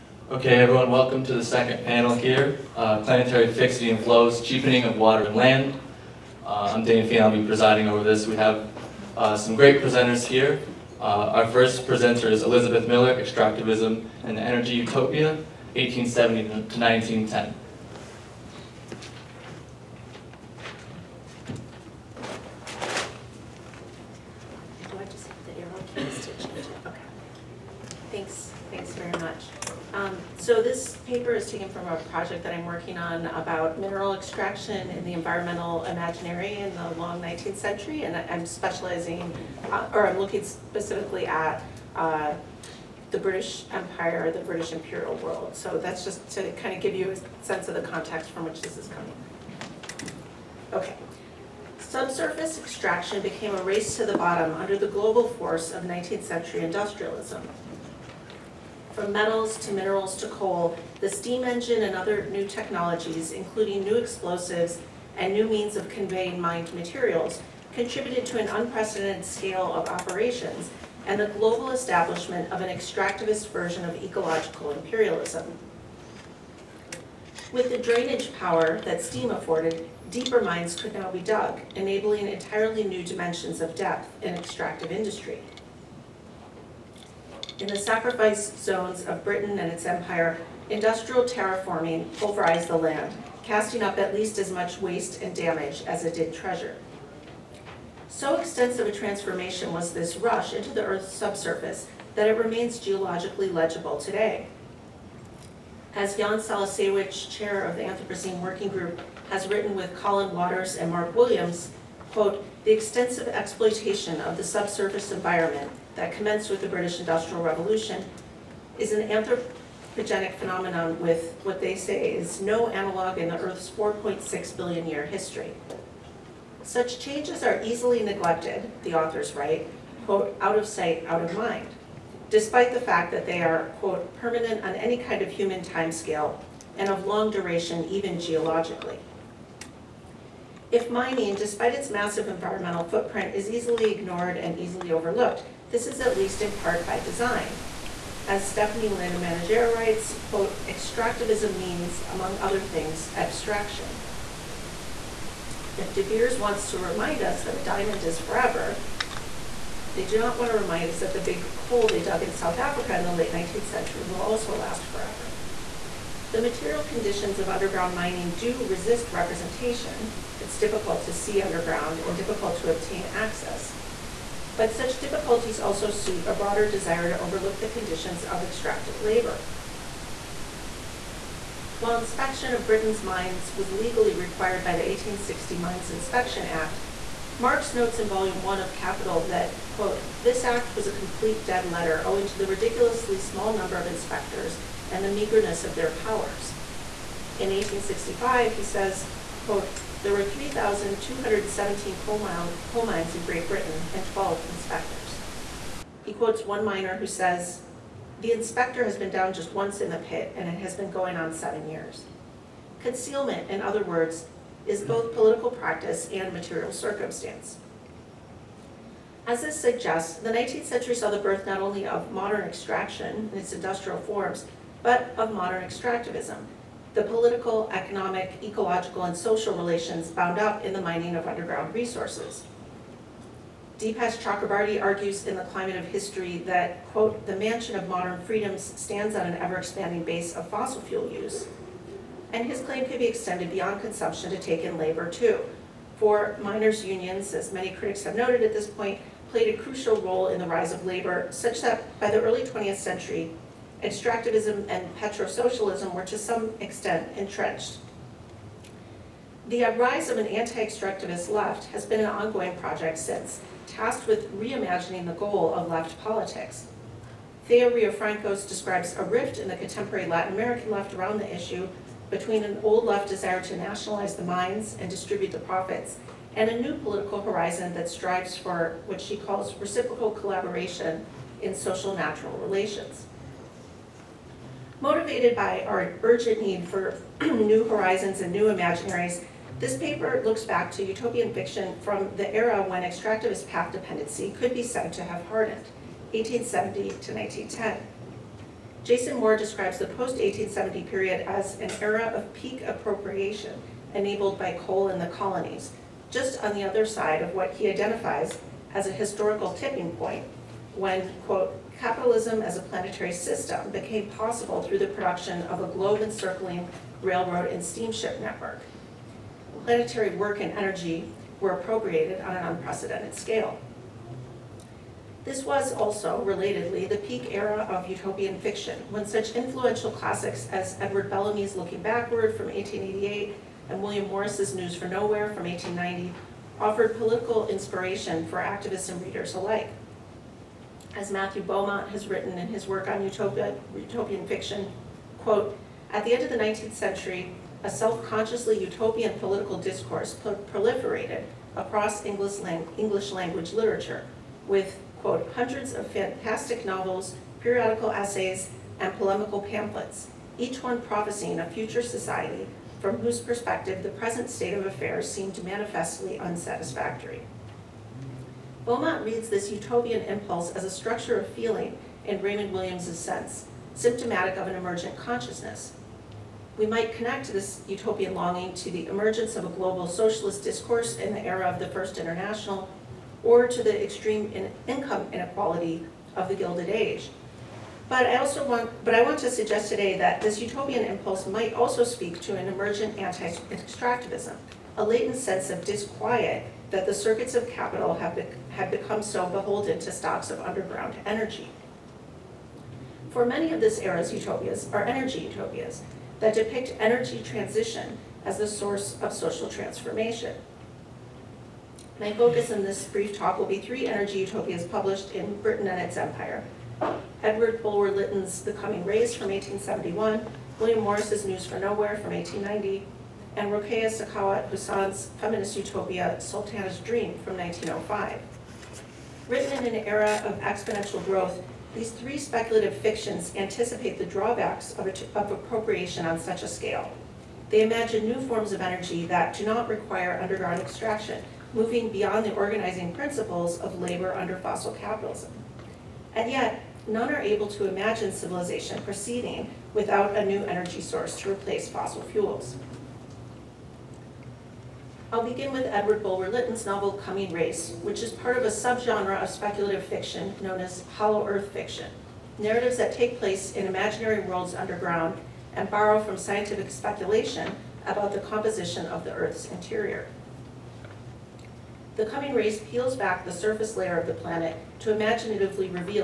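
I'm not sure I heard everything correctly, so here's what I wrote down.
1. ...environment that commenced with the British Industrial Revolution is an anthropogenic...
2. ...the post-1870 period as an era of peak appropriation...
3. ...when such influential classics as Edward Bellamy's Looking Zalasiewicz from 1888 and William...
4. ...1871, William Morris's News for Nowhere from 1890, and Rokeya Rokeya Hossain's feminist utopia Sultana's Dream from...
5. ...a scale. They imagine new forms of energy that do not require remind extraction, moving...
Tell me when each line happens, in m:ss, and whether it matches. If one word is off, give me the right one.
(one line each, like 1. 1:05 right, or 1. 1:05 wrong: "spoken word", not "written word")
1. 1:55 right
2. 4:59 right
3. 5:28 wrong: "Backward", not "Zalasiewicz"
4. 6:59 wrong: "Sakhawat", not "Rokeya"
5. 7:16 wrong: "underground", not "remind".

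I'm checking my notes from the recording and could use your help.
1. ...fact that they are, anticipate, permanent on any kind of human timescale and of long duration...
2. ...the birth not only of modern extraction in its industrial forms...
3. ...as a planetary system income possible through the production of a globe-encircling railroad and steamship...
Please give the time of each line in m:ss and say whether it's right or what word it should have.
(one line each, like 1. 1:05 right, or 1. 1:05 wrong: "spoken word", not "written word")
1. 2:12 wrong: "quote", not "anticipate"
2. 3:41 right
3. 5:12 wrong: "became", not "income".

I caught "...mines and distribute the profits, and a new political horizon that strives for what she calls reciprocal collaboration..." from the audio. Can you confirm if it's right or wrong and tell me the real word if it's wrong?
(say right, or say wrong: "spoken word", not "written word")
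right.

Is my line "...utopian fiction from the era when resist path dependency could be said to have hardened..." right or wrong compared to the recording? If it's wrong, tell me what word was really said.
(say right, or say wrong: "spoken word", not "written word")
wrong: "extractivist", not "resist".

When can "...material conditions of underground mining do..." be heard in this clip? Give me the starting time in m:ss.
2:46.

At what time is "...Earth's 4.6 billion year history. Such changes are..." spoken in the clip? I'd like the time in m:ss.
2:03.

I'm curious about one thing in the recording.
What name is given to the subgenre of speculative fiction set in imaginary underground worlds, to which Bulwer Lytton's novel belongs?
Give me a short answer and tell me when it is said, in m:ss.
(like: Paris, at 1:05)
hollow earth fiction, at 7:40.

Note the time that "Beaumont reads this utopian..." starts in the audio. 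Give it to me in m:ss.
6:08.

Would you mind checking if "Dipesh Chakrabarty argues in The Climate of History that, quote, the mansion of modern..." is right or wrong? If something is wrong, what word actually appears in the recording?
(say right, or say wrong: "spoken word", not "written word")
right.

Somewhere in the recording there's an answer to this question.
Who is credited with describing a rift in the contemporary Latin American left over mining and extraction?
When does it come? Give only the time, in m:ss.
4:27.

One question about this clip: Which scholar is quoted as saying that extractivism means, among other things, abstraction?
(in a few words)
Stephanie LeMenager.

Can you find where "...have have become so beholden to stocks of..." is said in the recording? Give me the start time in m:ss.
6:37.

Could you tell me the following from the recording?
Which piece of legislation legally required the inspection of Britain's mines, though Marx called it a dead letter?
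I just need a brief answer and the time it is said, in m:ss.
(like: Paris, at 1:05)
1860 Mines Inspection Act, at 3:04.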